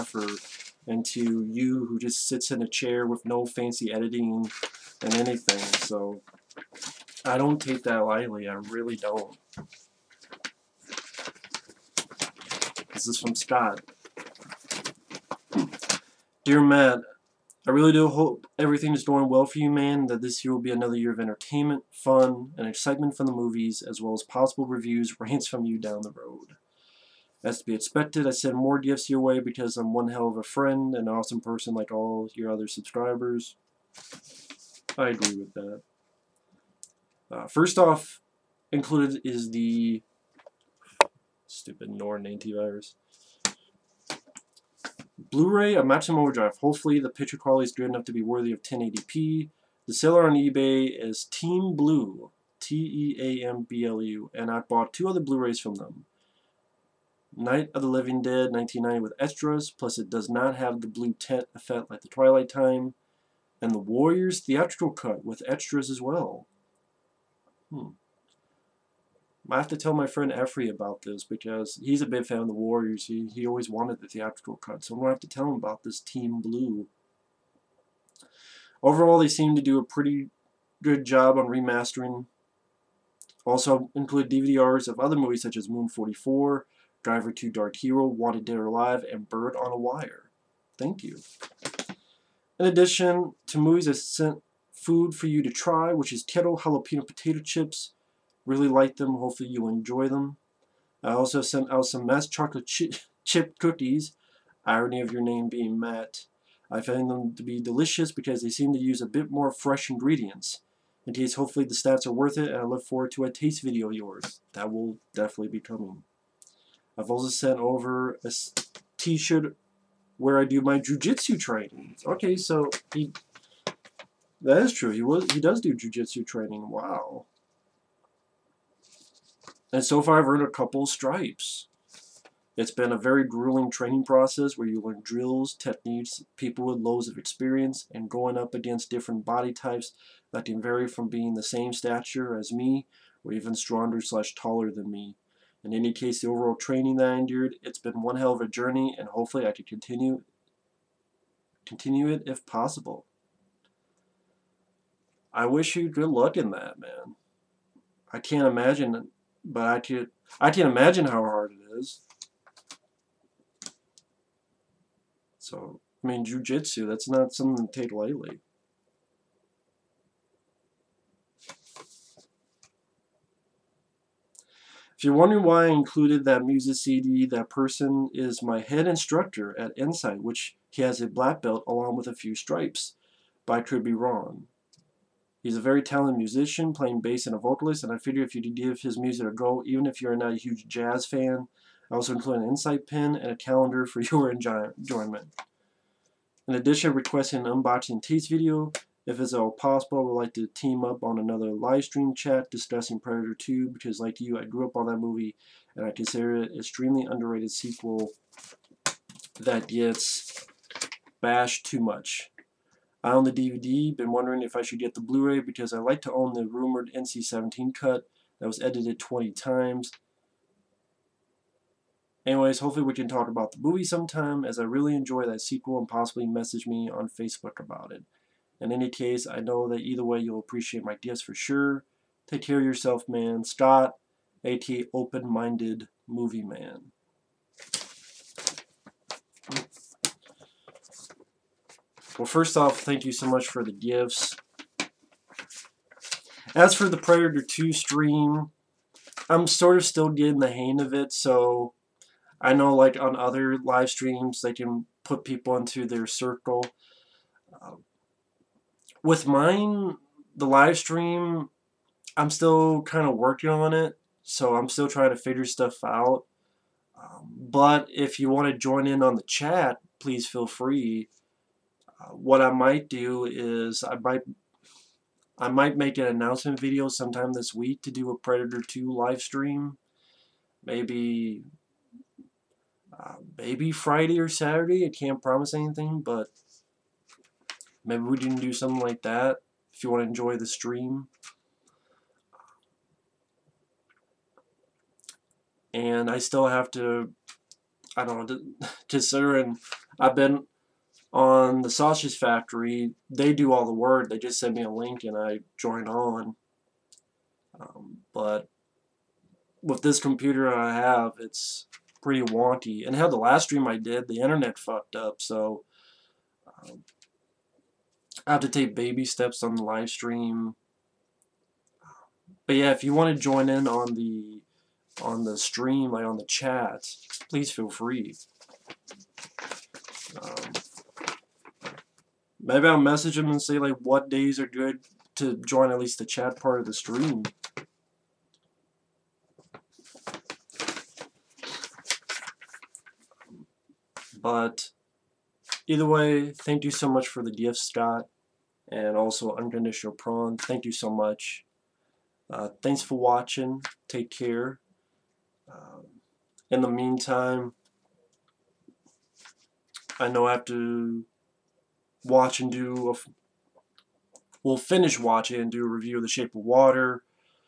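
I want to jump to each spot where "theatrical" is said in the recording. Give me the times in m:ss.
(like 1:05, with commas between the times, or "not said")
1:04, 1:14.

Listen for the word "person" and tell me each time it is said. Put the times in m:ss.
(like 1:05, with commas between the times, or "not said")
0:31, 2:57.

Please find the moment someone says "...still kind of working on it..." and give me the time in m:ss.
4:22.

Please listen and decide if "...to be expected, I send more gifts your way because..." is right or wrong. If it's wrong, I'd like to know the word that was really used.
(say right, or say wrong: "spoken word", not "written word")
right.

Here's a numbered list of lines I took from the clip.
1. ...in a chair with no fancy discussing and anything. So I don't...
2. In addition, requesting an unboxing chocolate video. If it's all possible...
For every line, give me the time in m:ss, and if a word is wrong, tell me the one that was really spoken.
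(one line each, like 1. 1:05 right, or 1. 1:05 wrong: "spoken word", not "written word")
1. 0:02 wrong: "editing", not "discussing"
2. 3:16 wrong: "taste", not "chocolate".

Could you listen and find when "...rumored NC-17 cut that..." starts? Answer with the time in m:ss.
3:36.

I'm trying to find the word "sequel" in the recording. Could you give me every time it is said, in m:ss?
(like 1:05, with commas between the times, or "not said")
3:27, 3:45.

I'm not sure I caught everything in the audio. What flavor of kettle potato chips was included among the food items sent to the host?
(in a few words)
jalapeno.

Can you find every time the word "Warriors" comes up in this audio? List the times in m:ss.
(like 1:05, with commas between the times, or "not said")
1:03, 1:12.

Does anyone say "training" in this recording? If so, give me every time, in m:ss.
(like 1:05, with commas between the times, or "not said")
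2:01, 2:06, 2:13, 2:26.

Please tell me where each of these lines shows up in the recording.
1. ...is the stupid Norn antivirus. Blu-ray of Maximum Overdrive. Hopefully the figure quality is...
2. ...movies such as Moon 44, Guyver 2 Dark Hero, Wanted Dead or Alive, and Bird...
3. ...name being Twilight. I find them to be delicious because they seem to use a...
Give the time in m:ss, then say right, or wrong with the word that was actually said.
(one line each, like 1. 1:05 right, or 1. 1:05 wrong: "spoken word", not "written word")
1. 0:39 wrong: "picture", not "figure"
2. 1:25 right
3. 1:45 wrong: "Matt", not "Twilight".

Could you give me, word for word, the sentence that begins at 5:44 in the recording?
But either way, thank you so much for the gift, Scott, and also Unconditional Prong.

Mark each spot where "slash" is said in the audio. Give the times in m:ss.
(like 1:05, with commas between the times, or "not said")
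2:24.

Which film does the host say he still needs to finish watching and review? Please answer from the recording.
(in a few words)
The Shape of Water.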